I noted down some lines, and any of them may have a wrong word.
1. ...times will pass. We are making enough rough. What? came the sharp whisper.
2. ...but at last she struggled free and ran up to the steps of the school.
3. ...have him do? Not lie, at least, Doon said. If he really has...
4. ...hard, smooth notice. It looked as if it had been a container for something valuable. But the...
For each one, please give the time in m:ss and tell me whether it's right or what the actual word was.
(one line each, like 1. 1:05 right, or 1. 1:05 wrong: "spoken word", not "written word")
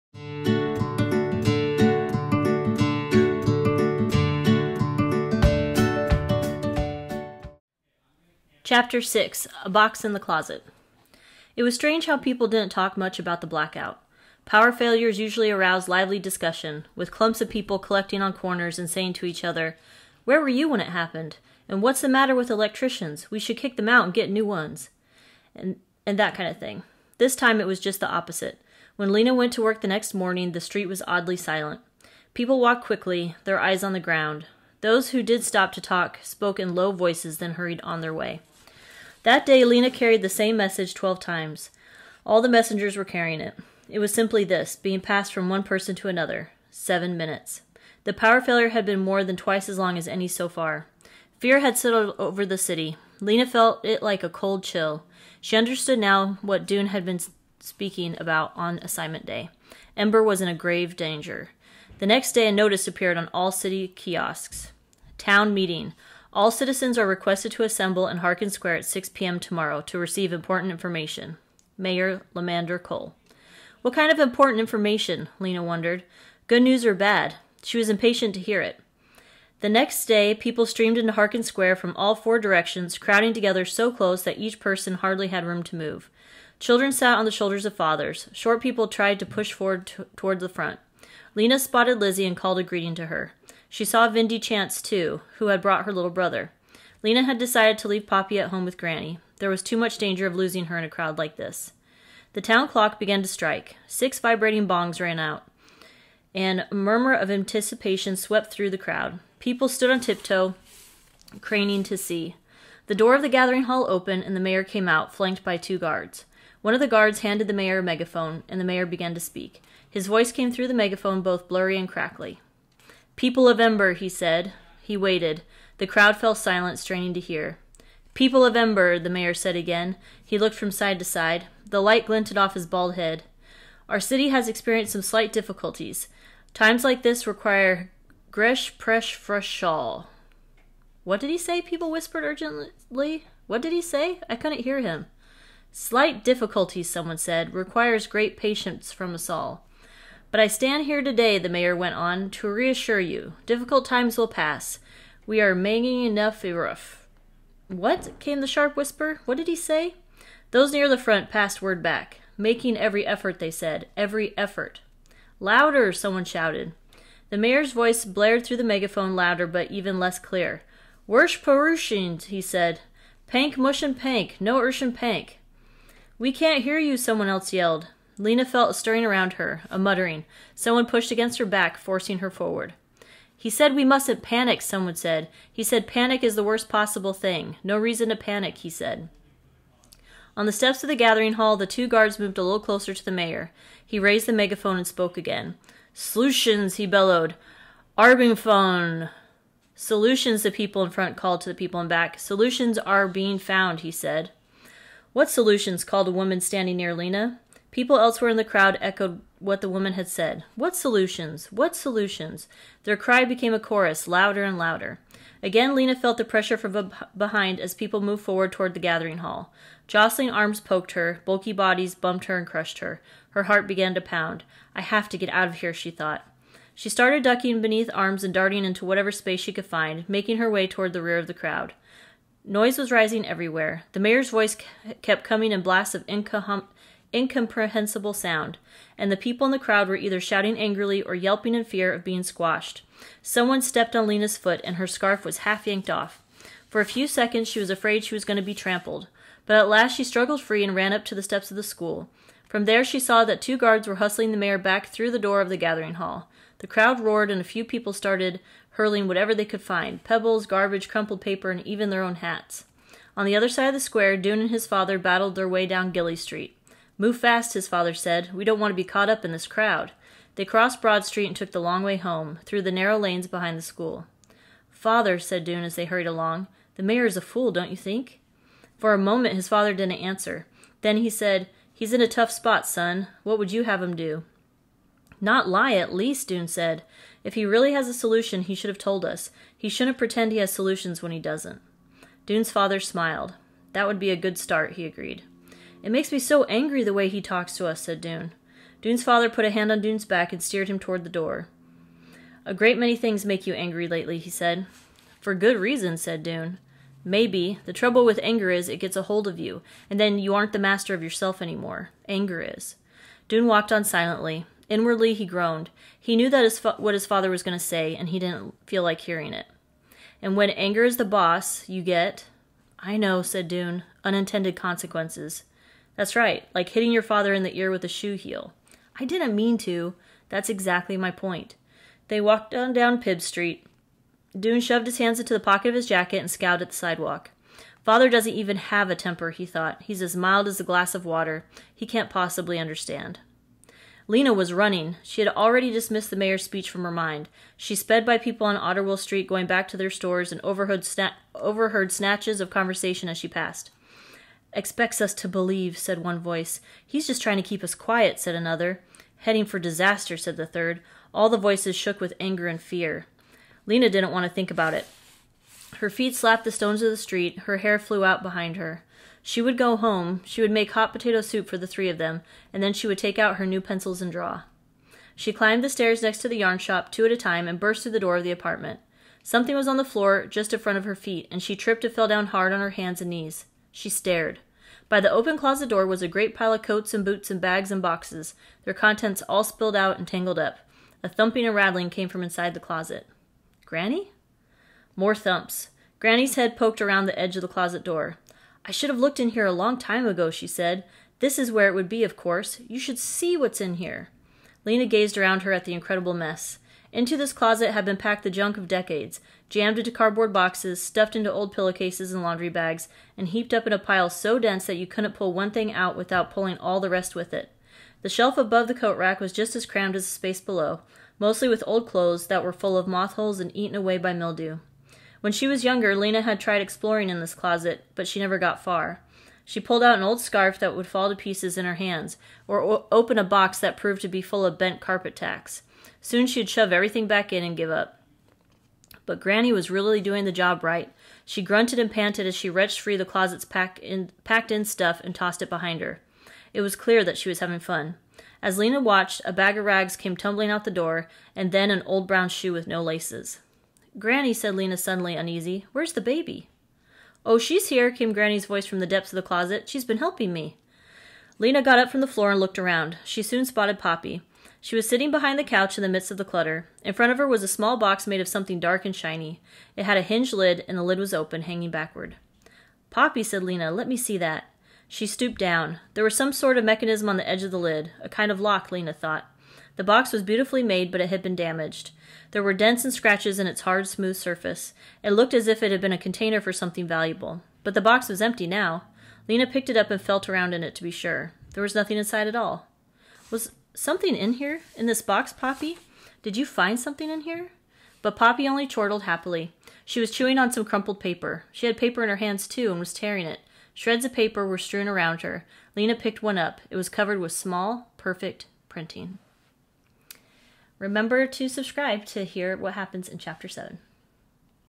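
1. 2:33 right
2. 4:09 right
3. 4:43 right
4. 8:03 wrong: "surface", not "notice".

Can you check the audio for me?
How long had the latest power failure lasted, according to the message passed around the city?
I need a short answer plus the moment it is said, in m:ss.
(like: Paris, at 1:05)
seven minutes, at 0:46.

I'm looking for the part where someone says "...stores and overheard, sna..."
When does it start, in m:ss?
5:49.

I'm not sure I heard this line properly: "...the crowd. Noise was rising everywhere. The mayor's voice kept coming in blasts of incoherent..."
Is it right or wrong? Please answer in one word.
right.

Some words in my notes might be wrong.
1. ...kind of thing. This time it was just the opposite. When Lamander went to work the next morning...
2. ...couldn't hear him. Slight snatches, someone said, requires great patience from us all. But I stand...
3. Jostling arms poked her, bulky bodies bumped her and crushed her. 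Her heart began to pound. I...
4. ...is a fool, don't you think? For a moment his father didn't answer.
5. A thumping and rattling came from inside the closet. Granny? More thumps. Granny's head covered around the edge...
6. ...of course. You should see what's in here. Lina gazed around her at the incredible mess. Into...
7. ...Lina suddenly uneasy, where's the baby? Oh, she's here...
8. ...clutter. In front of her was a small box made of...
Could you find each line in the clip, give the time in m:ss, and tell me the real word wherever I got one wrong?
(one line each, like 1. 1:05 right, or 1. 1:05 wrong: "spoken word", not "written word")
1. 0:26 wrong: "Lena", not "Lamander"
2. 2:24 wrong: "difficulties", not "snatches"
3. 3:39 right
4. 4:37 right
5. 6:31 wrong: "poked", not "covered"
6. 6:42 right
7. 7:34 right
8. 7:46 right.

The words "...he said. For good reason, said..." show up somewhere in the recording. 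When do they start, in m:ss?
5:04.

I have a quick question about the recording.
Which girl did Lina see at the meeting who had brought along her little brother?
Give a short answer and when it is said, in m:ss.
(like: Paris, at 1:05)
Vindy Chance, at 1:34.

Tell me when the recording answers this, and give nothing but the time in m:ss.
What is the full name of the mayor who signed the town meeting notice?
1:12.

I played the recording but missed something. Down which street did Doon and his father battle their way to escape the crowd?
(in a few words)
Gilly Street.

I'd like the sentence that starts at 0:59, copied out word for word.
Ember was in a grave danger.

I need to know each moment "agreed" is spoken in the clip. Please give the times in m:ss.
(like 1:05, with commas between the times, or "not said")
4:54.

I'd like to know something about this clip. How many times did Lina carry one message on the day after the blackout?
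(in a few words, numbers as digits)
12.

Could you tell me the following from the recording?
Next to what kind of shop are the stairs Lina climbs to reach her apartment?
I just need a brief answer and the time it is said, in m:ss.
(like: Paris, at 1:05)
yarn shop, at 6:16.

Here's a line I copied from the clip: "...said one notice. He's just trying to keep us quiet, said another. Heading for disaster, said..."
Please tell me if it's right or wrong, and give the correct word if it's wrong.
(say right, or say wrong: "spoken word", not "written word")
wrong: "voice", not "notice".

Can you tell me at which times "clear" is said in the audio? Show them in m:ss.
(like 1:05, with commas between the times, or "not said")
2:50, 7:26.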